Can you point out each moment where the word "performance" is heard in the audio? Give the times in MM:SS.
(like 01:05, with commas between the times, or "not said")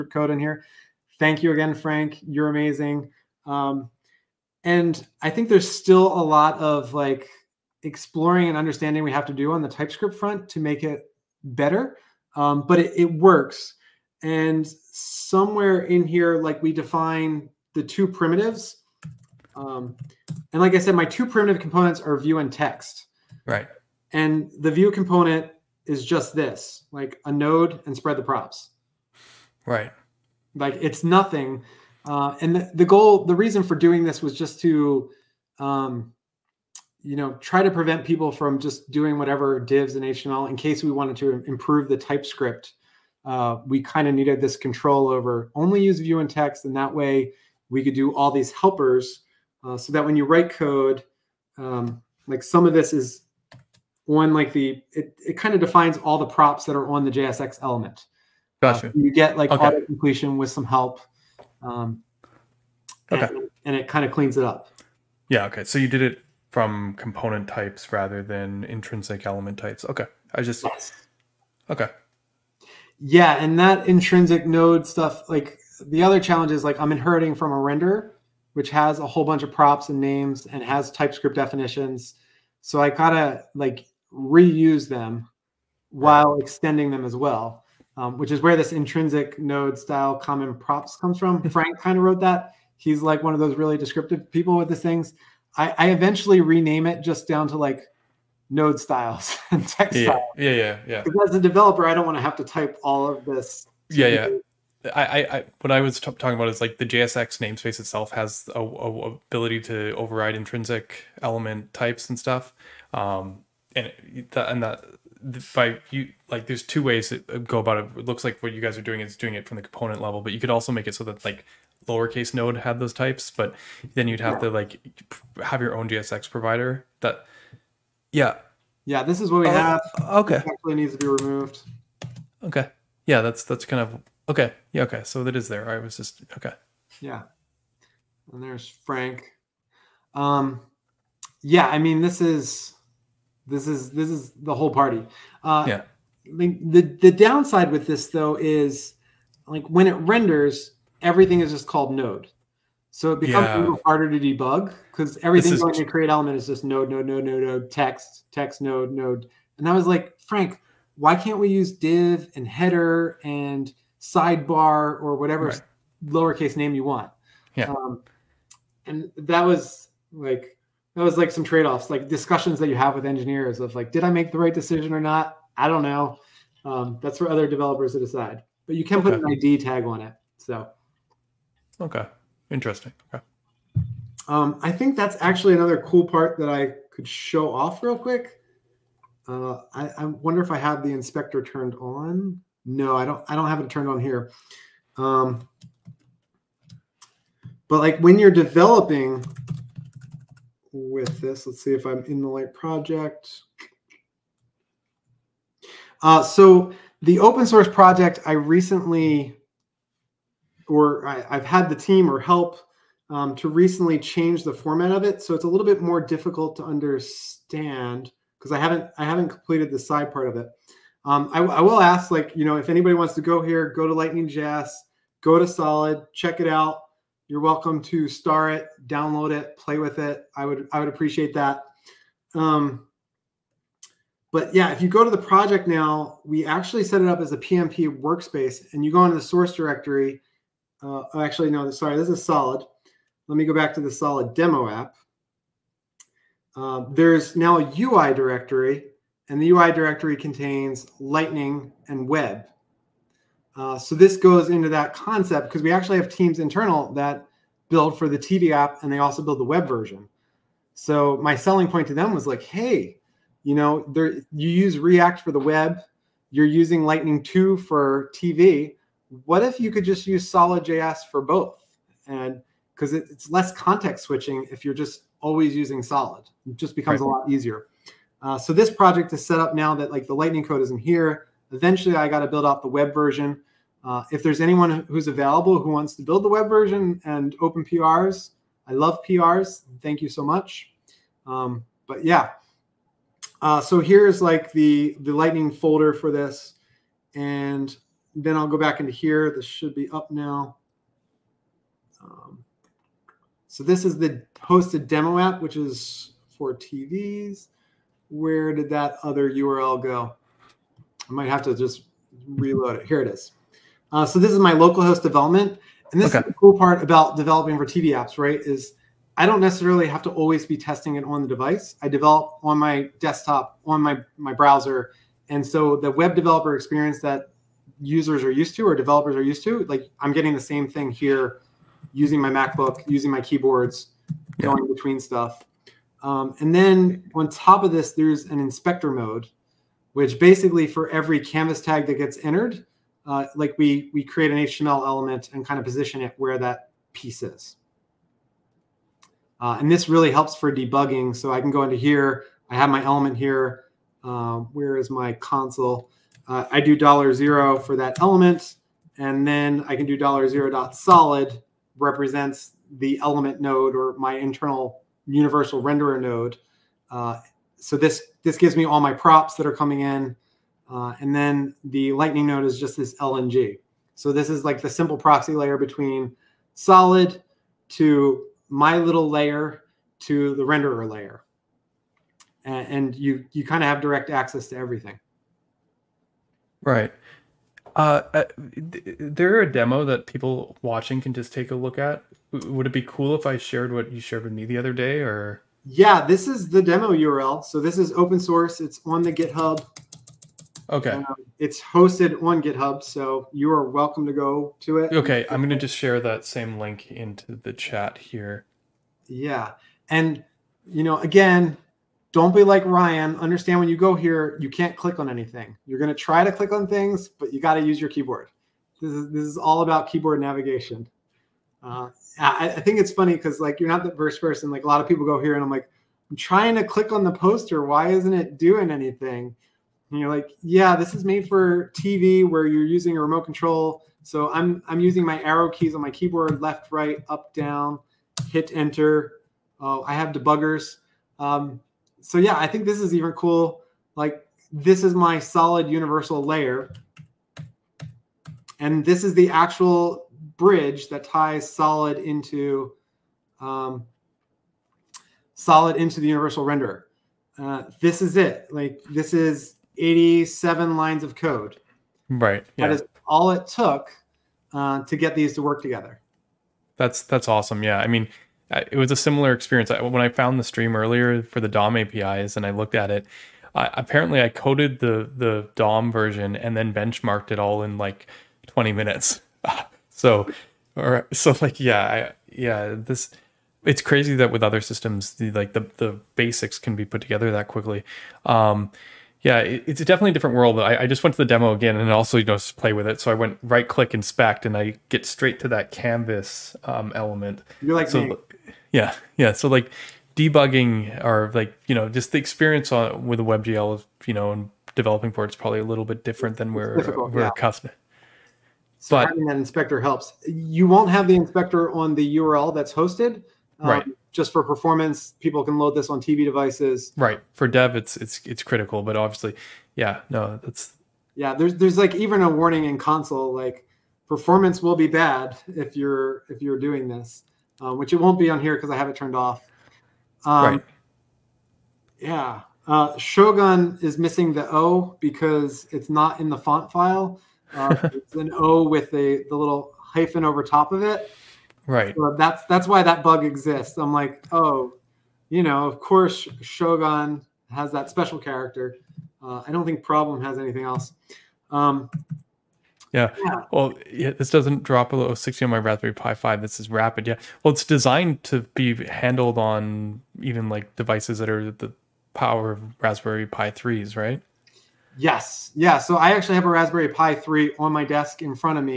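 08:34, 08:44.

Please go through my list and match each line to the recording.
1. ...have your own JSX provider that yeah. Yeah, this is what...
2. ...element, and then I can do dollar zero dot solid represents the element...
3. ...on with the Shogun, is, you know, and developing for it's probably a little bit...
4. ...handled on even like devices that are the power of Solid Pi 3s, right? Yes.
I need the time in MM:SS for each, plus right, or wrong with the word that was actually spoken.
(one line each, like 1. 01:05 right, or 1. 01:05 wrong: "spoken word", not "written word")
1. 02:05 right
2. 05:57 right
3. 08:22 wrong: "WebGL", not "Shogun"
4. 09:18 wrong: "Raspberry", not "Solid".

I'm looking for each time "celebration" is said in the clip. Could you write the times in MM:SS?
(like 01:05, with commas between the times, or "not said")
not said.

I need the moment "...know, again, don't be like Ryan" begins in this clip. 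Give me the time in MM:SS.
06:50.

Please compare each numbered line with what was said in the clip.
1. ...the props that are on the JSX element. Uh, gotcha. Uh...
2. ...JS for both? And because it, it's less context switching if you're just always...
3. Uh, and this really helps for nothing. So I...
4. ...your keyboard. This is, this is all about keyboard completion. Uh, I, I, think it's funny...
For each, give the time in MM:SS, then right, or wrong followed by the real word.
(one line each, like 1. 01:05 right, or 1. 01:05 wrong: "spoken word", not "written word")
1. 00:56 right
2. 04:30 right
3. 05:49 wrong: "debugging", not "nothing"
4. 06:57 wrong: "navigation", not "completion".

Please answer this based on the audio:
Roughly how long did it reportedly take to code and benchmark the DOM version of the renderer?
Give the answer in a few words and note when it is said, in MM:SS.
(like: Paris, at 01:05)
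20 minutes, at 07:58.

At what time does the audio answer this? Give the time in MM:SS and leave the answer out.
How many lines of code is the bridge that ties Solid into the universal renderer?
07:39.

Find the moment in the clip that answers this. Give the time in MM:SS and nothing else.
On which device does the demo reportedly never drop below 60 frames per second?
09:15.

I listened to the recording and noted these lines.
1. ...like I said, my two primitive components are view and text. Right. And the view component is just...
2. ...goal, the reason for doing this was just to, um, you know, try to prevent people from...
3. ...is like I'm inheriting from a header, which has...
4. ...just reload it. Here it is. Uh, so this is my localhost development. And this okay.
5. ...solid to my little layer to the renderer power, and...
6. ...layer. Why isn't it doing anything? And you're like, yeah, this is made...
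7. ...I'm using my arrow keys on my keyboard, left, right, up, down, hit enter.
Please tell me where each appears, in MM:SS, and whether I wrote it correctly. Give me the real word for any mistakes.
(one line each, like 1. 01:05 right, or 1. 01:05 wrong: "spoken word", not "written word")
1. 00:20 right
2. 00:32 right
3. 01:16 wrong: "render", not "header"
4. 05:11 right
5. 06:16 wrong: "layer", not "power"
6. 07:07 wrong: "poster", not "layer"
7. 07:14 right.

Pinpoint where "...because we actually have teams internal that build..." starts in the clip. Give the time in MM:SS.
04:15.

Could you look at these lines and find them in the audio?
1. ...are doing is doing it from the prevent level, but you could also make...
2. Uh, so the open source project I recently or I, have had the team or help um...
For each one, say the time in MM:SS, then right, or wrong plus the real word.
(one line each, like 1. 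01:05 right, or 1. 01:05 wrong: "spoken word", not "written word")
1. 01:58 wrong: "component", not "prevent"
2. 03:26 right.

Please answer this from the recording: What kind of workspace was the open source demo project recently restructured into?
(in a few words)
PNPM workspace.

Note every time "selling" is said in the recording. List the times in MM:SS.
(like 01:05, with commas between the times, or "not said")
04:21.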